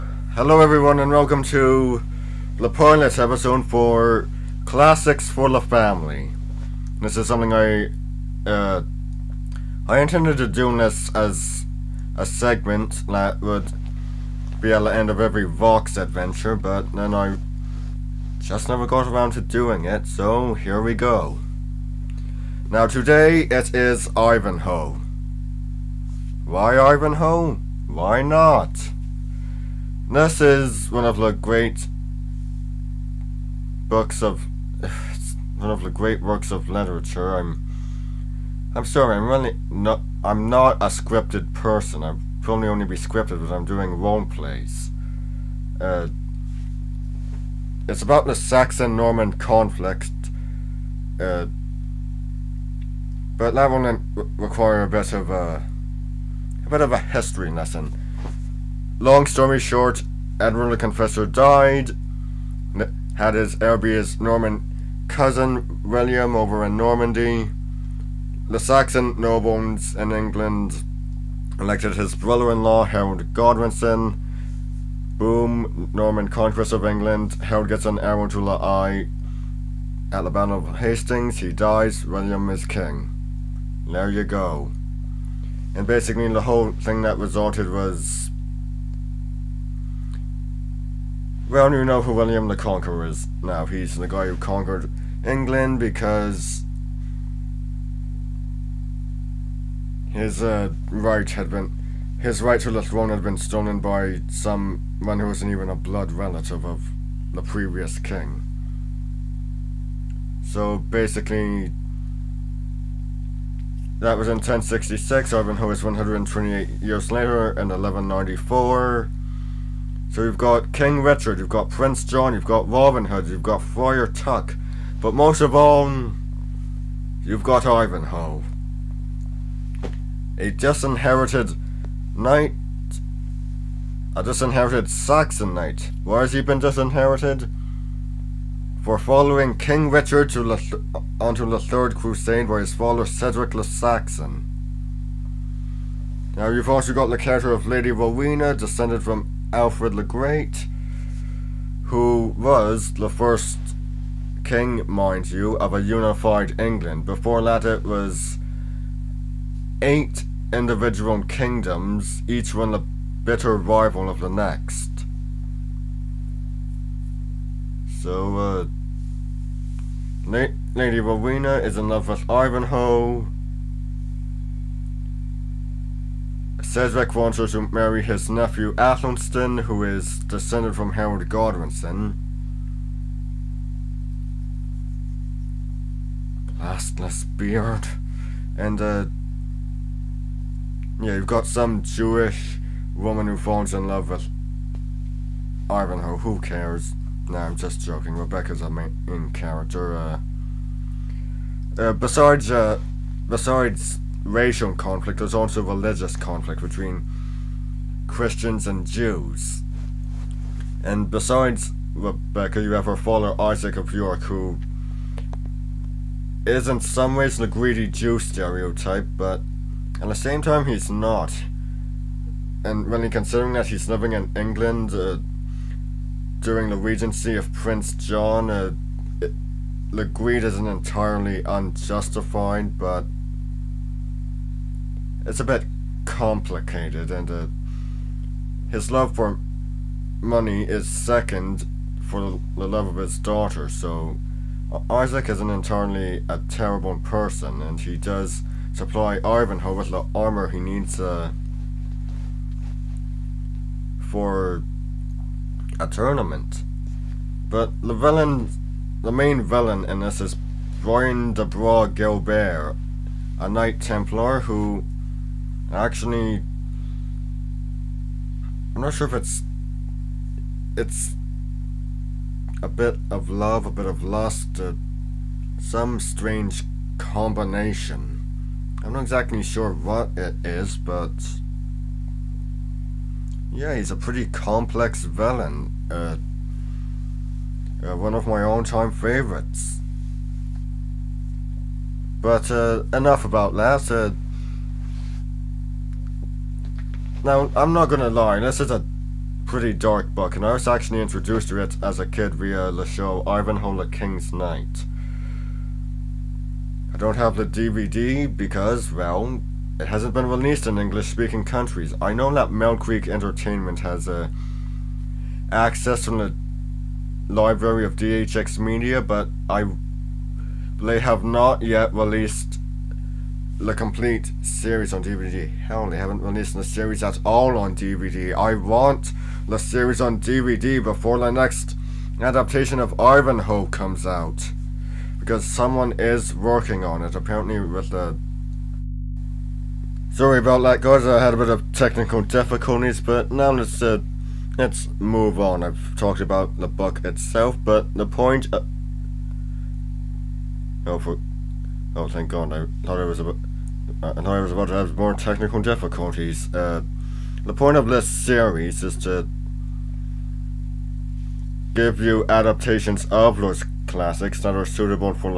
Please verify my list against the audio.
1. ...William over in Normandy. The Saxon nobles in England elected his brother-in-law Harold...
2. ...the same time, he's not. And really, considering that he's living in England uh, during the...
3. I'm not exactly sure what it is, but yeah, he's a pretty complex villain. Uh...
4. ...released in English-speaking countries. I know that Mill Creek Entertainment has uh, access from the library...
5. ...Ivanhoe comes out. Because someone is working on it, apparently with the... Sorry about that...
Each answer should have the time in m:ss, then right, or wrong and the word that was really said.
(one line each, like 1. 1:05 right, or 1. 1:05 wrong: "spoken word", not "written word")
1. 1:05 right
2. 3:40 right
3. 4:38 right
4. 5:10 right
5. 5:32 right.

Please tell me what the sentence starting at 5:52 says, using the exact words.
I thought it was a uh, and I was about to have more technical difficulties.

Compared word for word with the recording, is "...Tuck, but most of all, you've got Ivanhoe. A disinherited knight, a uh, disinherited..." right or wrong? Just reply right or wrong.
right.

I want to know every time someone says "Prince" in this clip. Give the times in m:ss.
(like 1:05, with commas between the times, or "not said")
2:01, 3:47.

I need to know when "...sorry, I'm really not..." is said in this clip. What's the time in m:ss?
0:38.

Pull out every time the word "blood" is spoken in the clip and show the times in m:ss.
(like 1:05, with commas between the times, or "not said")
1:45.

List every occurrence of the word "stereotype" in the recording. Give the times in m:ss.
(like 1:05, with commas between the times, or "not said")
3:38.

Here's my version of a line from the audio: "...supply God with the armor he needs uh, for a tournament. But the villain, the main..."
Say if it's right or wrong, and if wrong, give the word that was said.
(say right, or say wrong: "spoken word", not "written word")
wrong: "Ivanhoe", not "God".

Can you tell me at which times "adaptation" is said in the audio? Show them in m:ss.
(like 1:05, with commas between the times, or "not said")
5:32, 6:02.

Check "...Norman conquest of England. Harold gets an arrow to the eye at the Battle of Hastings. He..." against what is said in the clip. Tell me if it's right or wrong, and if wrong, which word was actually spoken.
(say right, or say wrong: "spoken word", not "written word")
right.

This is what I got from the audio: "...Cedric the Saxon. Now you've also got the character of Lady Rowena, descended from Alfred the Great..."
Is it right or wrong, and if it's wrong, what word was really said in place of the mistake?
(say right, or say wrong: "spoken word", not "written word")
right.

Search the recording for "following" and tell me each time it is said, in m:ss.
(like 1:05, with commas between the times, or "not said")
2:18.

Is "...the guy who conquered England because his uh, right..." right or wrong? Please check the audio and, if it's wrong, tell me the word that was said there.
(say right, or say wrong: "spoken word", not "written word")
right.